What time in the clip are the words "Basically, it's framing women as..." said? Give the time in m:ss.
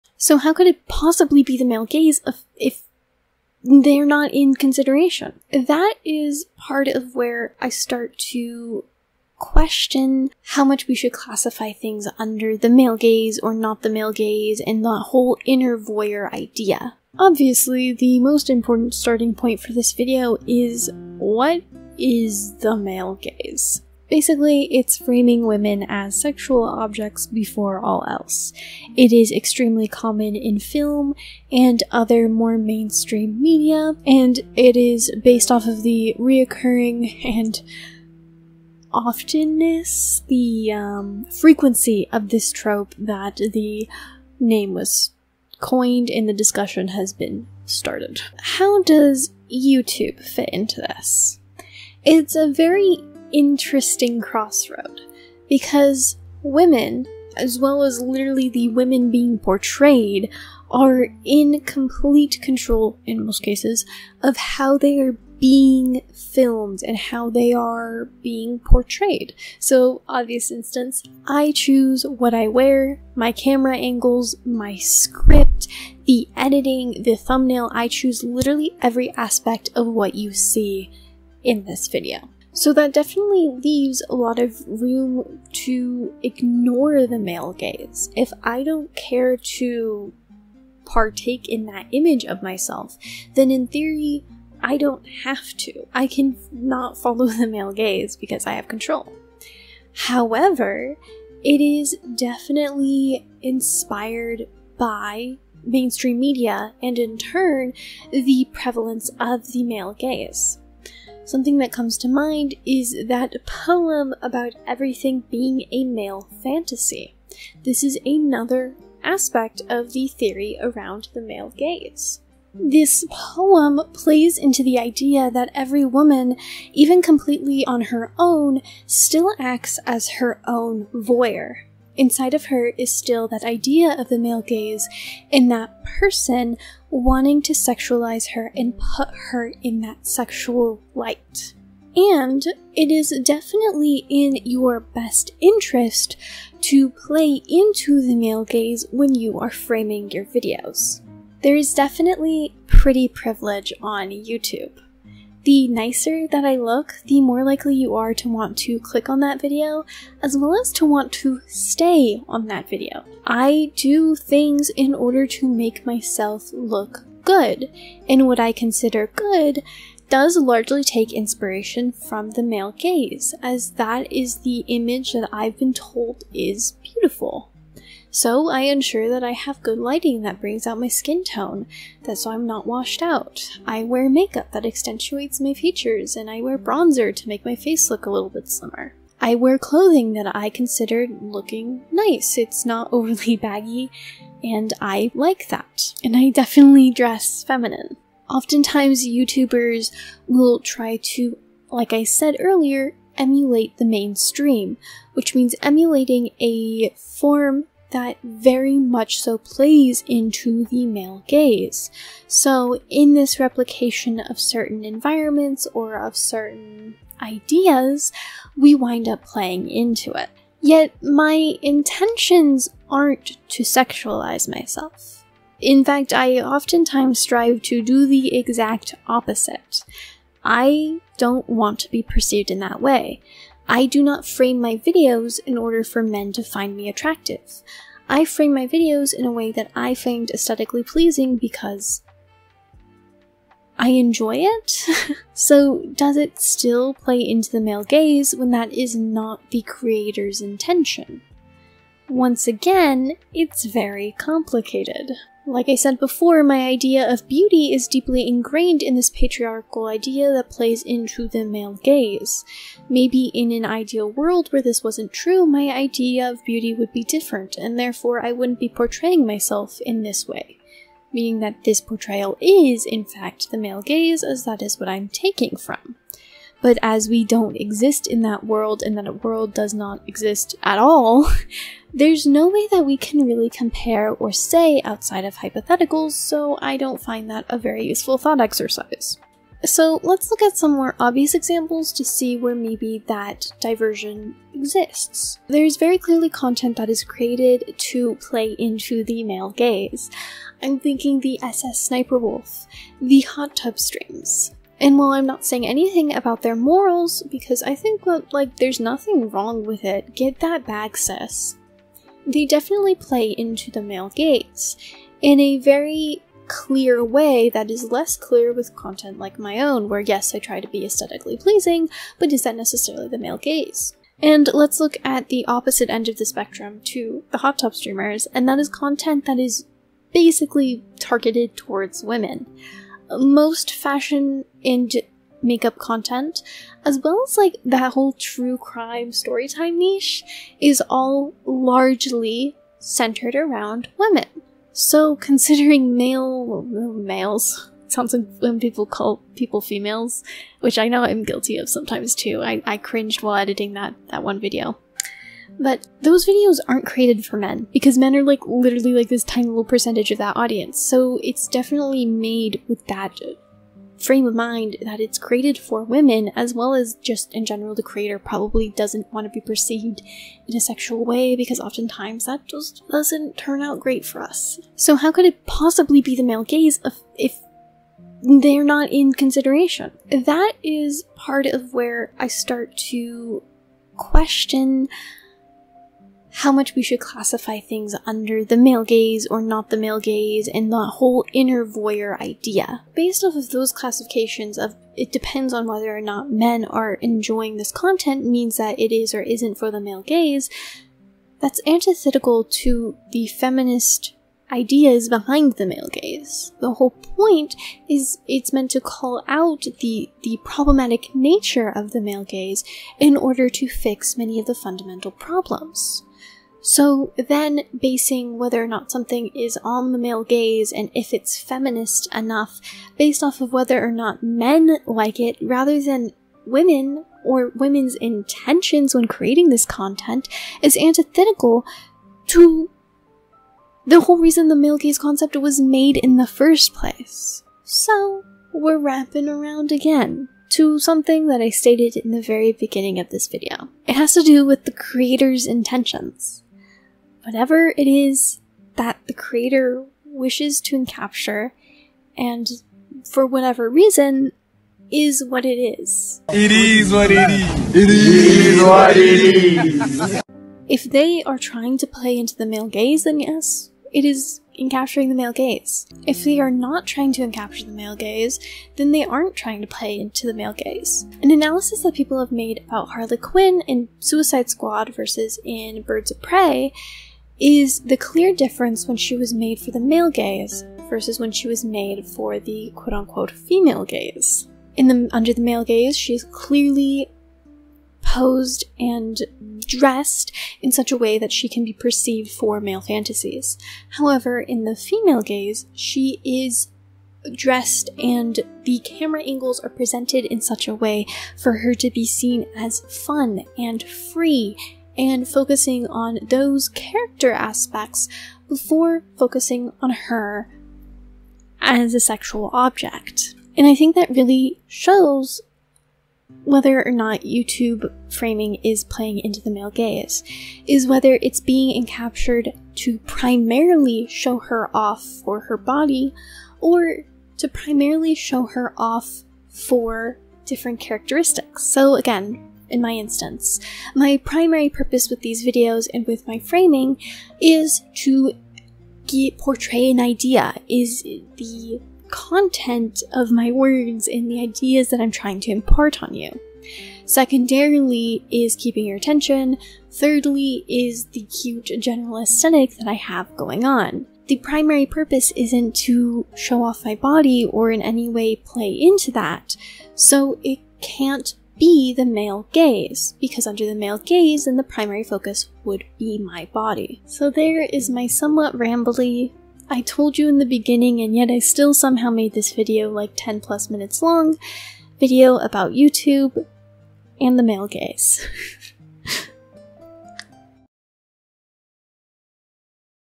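0:24.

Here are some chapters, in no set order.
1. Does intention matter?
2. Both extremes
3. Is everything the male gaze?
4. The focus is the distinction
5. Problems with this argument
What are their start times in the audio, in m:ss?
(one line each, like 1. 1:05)
1. 3:40
2. 4:48
3. 1:50
4. 7:26
5. 6:15.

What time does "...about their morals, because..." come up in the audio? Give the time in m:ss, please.
5:06.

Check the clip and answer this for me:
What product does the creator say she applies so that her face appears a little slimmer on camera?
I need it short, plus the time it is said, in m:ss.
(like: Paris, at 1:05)
Bronzer, at 3:06.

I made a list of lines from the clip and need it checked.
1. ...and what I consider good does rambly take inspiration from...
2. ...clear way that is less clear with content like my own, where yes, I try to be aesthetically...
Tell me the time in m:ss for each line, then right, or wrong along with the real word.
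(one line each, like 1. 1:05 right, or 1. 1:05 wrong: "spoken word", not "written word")
1. 2:48 wrong: "largely", not "rambly"
2. 5:16 right.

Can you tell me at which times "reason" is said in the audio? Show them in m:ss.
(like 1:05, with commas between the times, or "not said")
7:14, 7:33.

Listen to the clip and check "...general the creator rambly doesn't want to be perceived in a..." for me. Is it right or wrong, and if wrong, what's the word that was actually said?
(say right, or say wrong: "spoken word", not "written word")
wrong: "probably", not "rambly".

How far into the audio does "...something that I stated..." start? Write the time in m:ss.
7:20.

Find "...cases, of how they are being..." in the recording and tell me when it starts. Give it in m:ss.
1:03.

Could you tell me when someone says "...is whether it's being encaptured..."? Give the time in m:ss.
8:40.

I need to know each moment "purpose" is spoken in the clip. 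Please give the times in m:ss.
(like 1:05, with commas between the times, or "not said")
8:54, 9:14.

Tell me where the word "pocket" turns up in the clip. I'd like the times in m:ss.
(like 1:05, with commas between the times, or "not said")
not said.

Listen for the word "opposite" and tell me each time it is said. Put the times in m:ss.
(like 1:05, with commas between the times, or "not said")
3:49, 5:25.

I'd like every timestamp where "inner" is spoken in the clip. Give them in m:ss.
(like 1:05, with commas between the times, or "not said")
0:15, 6:31.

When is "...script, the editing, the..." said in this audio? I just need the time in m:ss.
1:14.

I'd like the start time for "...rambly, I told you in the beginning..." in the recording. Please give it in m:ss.
9:28.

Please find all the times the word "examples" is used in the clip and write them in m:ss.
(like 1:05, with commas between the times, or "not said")
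4:51.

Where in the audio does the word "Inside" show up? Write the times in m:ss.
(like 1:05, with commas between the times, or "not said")
2:11.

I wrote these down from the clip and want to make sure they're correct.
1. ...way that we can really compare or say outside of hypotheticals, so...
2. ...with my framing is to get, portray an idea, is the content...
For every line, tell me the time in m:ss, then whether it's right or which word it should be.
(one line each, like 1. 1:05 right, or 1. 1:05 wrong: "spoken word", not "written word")
1. 4:42 right
2. 8:56 right.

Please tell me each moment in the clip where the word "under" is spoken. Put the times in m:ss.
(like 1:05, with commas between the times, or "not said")
0:12, 6:28, 8:05, 9:23.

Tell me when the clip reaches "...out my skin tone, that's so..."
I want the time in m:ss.
3:00.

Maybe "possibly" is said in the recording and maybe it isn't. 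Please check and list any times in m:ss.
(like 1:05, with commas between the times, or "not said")
0:00, 6:15.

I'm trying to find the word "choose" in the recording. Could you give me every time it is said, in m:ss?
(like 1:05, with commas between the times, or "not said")
1:11, 1:17.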